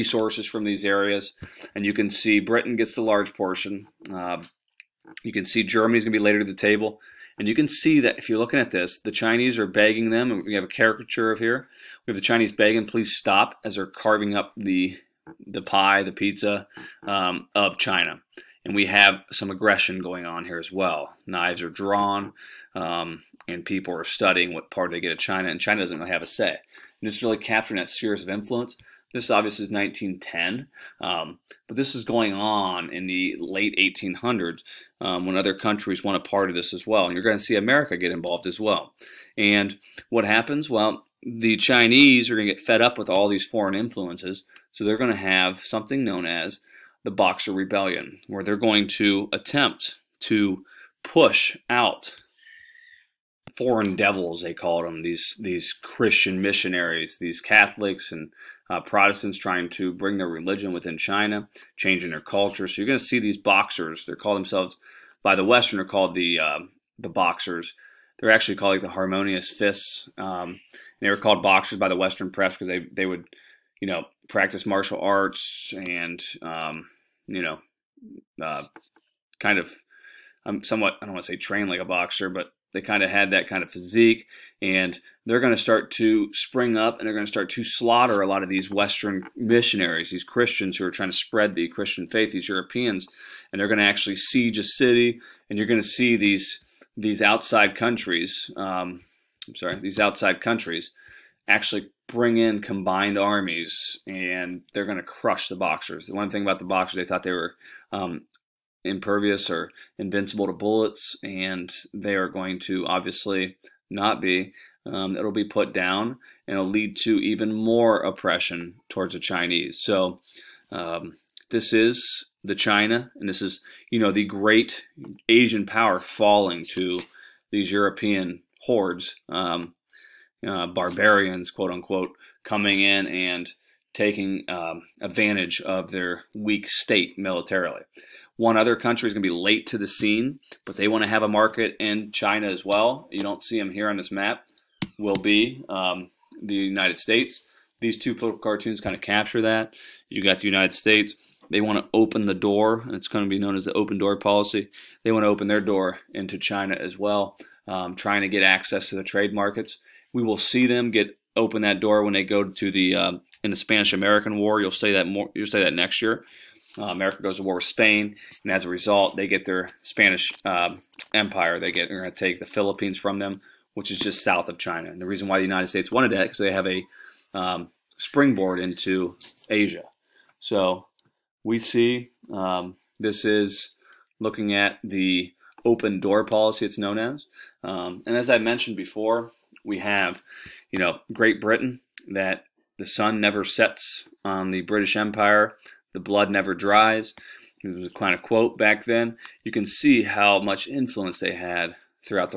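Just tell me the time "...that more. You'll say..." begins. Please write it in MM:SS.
02:44.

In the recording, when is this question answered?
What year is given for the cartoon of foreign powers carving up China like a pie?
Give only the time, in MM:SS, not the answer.
00:29.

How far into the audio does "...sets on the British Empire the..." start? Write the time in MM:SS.
03:13.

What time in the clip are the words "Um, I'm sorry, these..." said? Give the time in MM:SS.
01:38.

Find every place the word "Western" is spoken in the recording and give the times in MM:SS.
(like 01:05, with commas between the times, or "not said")
01:05, 01:11, 01:28.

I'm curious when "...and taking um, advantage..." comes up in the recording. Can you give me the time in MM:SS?
02:13.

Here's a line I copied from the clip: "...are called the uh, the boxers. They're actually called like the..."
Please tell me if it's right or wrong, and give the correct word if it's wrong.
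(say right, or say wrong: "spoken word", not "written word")
right.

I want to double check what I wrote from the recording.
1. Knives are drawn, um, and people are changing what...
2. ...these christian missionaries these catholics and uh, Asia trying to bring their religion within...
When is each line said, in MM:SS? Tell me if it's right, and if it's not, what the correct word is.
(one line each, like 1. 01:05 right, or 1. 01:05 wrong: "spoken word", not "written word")
1. 00:21 wrong: "studying", not "changing"
2. 00:55 wrong: "Protestants", not "Asia".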